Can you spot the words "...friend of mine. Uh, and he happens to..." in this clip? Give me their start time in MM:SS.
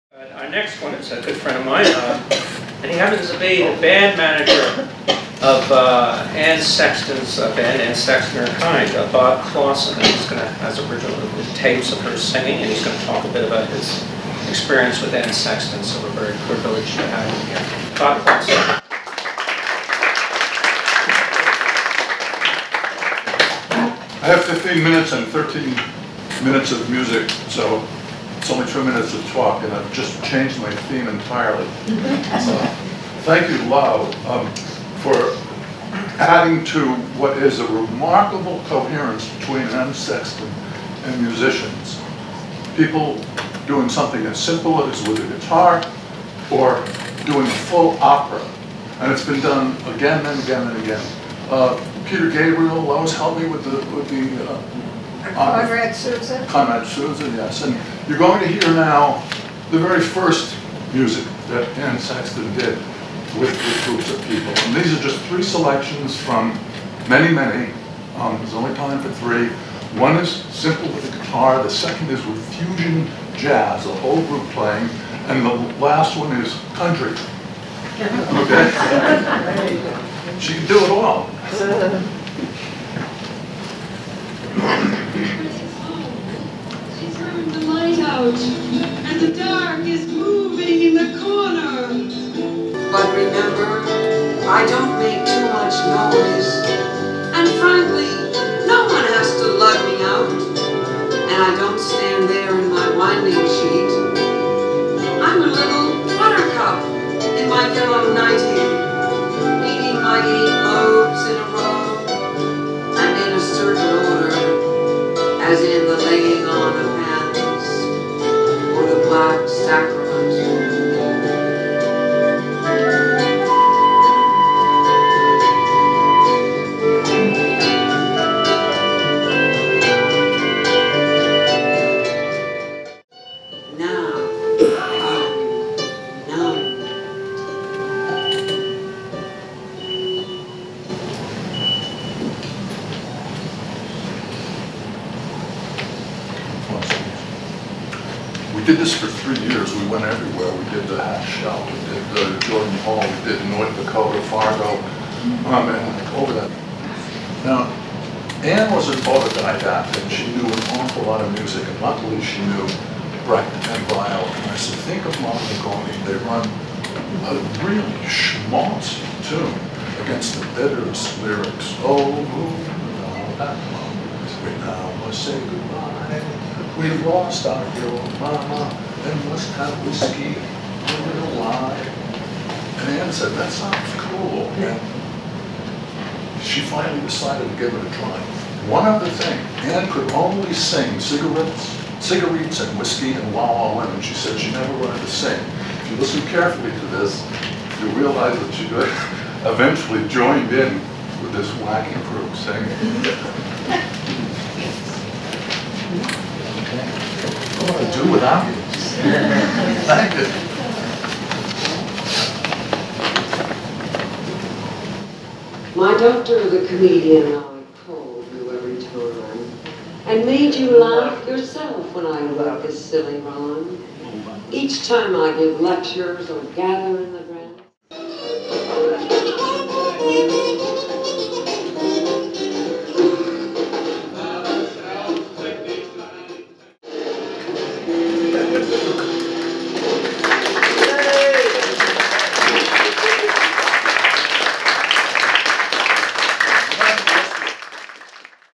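00:01.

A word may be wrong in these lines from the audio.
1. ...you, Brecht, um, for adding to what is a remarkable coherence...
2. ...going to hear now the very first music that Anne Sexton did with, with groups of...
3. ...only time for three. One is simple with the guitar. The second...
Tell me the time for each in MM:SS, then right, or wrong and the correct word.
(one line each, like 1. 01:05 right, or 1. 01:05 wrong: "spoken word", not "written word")
1. 00:33 wrong: "Lau", not "Brecht"
2. 00:58 right
3. 01:08 right.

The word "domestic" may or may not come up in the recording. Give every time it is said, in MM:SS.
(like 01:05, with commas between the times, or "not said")
not said.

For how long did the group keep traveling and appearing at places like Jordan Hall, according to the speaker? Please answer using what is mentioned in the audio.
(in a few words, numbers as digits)
3 years.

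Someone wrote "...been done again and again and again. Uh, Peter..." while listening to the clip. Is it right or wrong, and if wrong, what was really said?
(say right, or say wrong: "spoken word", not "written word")
right.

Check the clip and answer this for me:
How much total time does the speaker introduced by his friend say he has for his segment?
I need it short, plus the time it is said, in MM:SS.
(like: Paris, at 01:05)
15 minutes, at 00:24.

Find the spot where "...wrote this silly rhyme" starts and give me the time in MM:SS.
03:42.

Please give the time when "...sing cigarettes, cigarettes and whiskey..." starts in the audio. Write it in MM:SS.
03:10.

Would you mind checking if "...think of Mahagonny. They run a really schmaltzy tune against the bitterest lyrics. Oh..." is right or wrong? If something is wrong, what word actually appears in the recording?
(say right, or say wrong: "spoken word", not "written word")
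right.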